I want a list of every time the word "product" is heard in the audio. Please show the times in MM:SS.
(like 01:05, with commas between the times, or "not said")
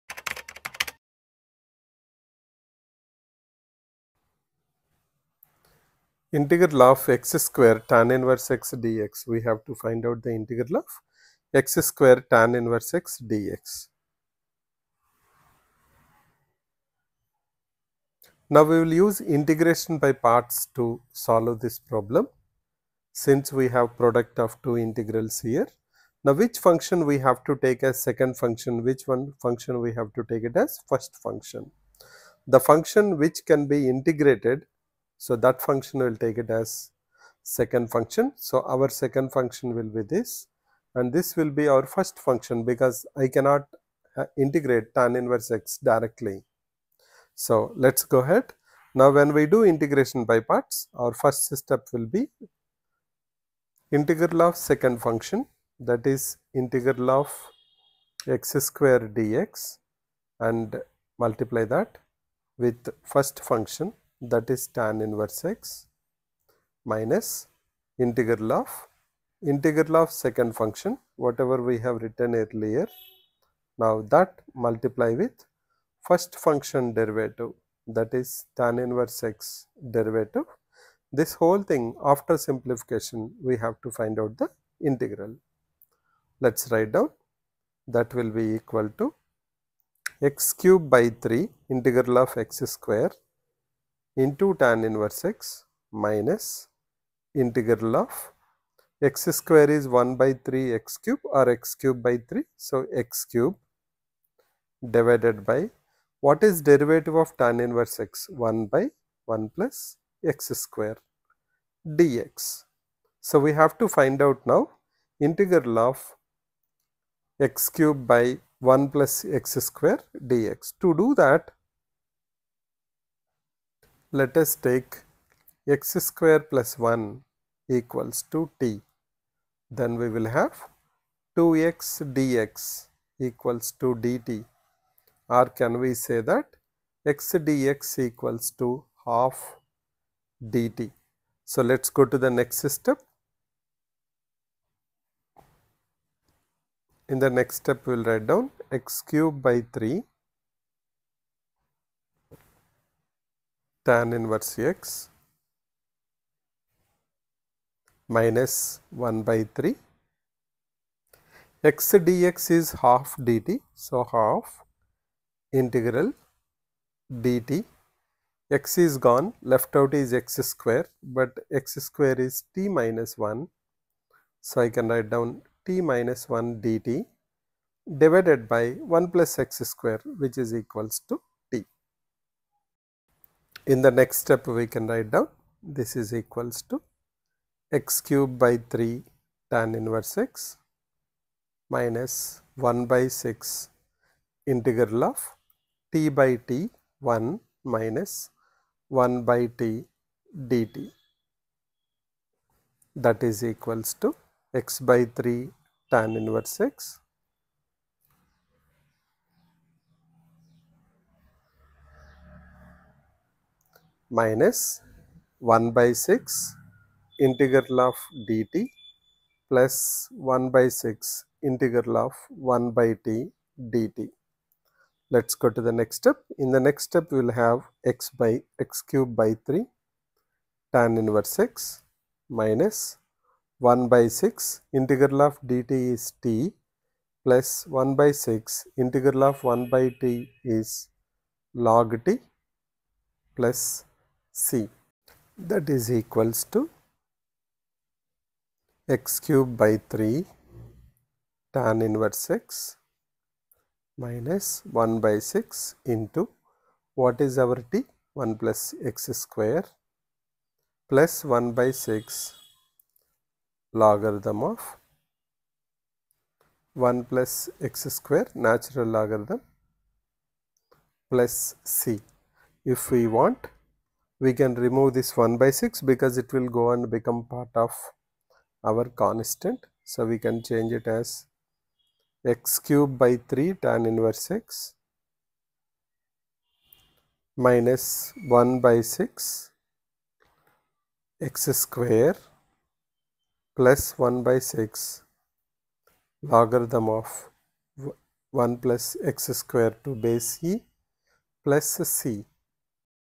00:23.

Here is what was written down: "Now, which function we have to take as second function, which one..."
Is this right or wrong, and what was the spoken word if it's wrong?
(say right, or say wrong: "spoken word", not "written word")
right.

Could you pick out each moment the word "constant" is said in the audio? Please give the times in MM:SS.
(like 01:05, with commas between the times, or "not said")
04:38.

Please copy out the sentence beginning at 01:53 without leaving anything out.
So, we have to find out now integral of x cube by 1 plus x square dx.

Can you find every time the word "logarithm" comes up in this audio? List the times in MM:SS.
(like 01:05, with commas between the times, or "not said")
04:23, 04:28, 04:56.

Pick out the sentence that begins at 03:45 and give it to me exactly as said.
Let's go to the next step.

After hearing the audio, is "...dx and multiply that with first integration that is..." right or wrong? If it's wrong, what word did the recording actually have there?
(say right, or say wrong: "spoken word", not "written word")
wrong: "function", not "integration".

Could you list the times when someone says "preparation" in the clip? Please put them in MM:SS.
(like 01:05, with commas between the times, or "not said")
not said.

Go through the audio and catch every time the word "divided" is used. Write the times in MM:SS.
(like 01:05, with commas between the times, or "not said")
01:44, 02:58.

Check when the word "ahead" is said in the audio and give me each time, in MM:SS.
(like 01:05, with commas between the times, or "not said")
00:48.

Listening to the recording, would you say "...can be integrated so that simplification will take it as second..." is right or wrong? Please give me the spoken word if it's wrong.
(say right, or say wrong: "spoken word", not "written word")
wrong: "function", not "simplification".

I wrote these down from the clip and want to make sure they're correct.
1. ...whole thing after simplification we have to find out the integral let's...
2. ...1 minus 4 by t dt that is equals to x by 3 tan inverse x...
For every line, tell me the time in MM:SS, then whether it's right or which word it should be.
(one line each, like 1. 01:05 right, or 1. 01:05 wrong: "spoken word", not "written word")
1. 01:21 right
2. 03:17 wrong: "1", not "4".